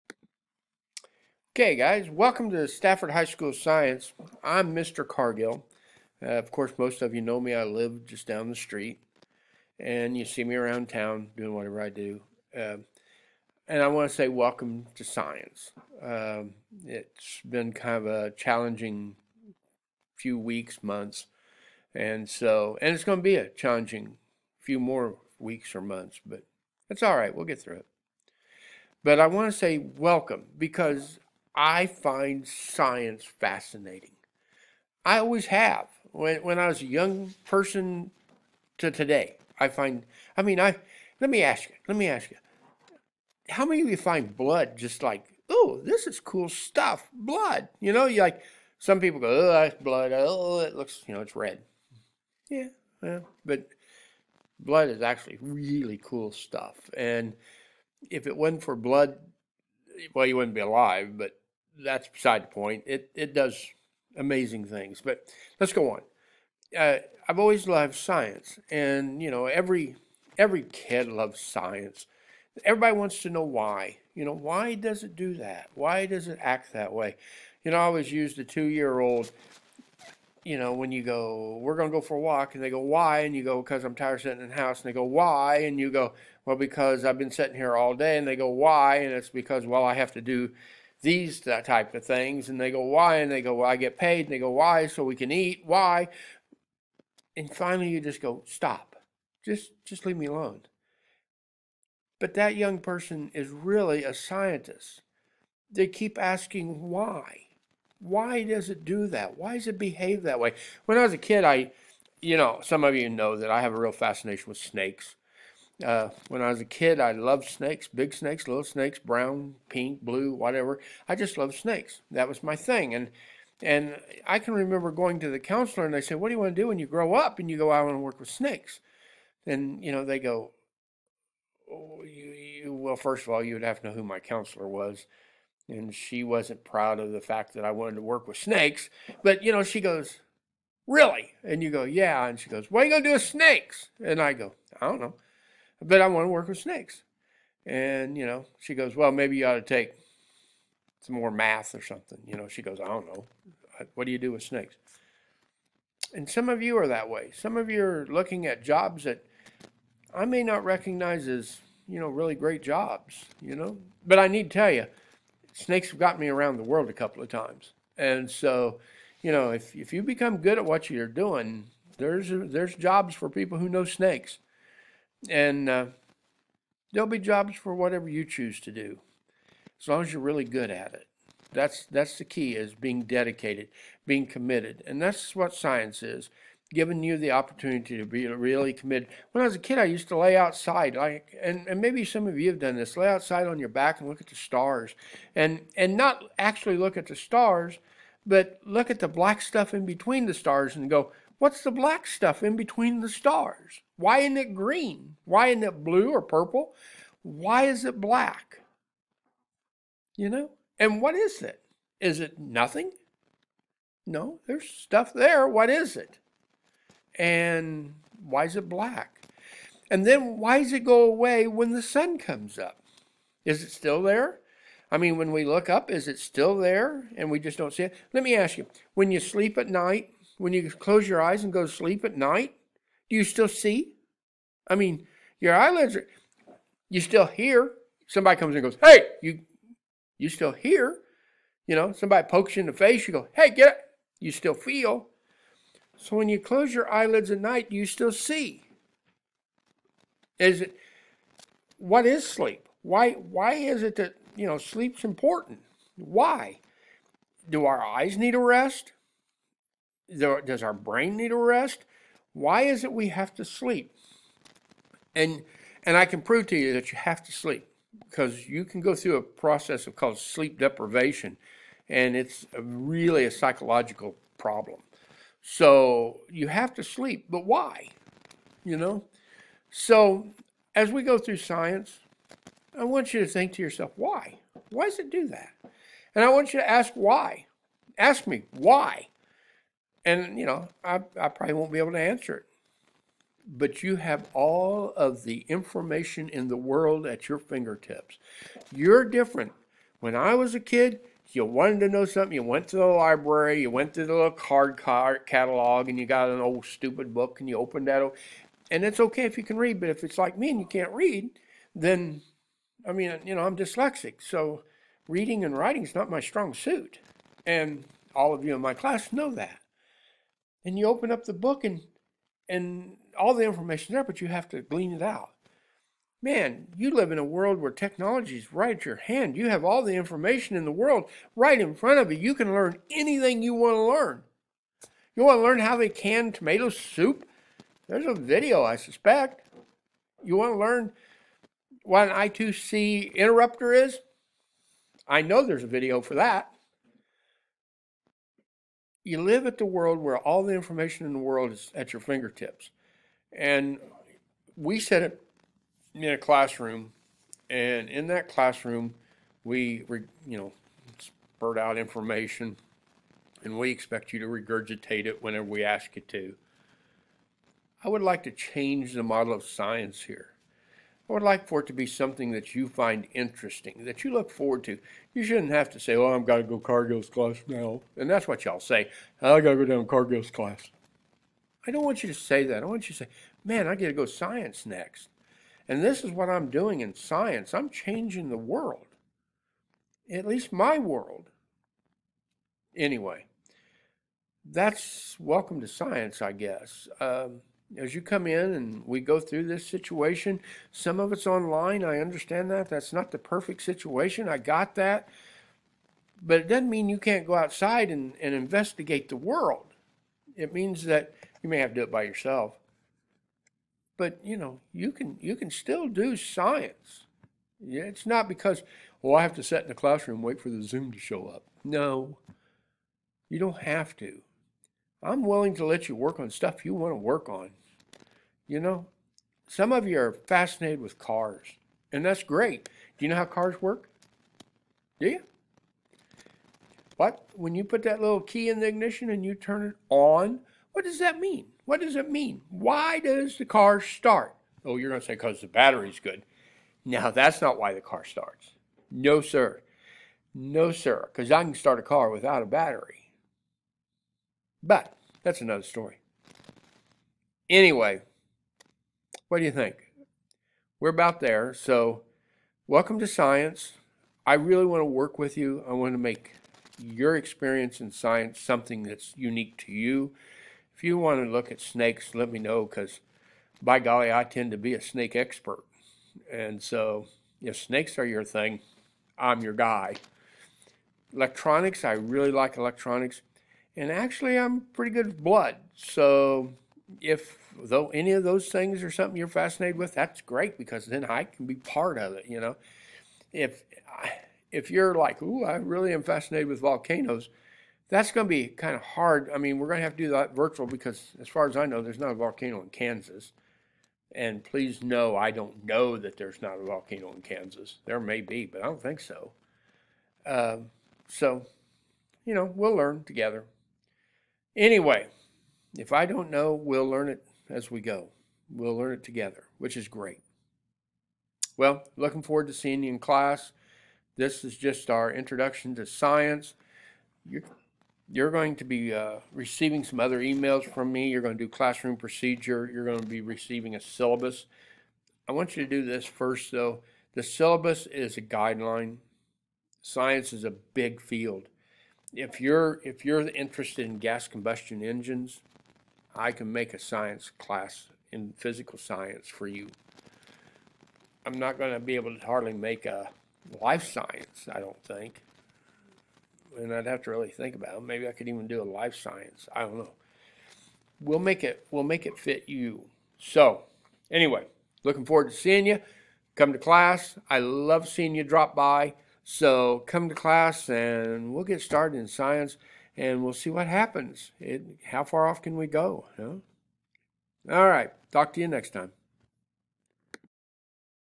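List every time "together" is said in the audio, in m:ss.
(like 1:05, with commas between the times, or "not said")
8:33, 8:39.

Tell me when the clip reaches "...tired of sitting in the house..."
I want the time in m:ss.
1:23.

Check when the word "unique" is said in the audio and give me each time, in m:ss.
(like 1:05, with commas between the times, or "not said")
7:49.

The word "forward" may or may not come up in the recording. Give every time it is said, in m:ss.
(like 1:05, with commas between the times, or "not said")
6:14, 8:42, 9:25.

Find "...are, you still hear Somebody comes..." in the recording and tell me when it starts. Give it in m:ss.
3:55.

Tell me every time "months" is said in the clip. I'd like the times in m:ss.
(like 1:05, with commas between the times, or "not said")
0:20, 0:25.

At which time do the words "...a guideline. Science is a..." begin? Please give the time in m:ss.
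8:58.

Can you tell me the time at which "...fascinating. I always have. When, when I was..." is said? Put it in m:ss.
0:33.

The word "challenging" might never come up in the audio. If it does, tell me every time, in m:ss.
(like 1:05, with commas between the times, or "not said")
0:18, 0:23.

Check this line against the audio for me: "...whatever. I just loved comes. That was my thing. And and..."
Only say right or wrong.
wrong.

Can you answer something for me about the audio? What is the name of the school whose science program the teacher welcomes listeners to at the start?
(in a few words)
Stafford High School.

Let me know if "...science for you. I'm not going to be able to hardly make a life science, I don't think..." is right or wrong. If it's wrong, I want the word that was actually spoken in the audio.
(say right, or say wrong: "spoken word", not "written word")
right.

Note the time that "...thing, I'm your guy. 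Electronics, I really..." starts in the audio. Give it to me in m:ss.
7:58.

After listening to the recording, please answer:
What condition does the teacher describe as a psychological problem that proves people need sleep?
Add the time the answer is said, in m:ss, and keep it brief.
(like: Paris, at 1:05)
Sleep deprivation, at 4:30.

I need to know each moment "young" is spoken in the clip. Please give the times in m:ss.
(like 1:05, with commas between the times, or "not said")
0:36, 1:42.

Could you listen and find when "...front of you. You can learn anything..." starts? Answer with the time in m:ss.
5:31.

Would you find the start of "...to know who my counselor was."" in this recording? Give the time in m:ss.
2:13.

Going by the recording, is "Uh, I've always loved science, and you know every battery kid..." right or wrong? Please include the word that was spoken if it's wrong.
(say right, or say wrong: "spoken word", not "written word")
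wrong: "every", not "battery".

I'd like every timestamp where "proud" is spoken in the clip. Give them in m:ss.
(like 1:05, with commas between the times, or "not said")
2:16.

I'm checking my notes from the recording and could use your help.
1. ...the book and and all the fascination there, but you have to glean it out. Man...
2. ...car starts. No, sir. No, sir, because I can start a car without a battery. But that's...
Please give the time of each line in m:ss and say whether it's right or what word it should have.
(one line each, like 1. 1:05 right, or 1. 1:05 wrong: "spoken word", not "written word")
1. 5:21 wrong: "information", not "fascination"
2. 7:27 right.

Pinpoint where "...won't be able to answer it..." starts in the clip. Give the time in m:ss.
4:51.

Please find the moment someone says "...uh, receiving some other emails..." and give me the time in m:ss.
8:48.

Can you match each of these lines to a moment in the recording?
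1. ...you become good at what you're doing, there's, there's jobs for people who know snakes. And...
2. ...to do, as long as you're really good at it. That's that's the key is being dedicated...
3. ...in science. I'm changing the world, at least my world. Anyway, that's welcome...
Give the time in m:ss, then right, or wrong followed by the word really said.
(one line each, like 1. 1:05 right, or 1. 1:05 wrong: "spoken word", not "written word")
1. 2:49 right
2. 2:58 right
3. 6:26 right.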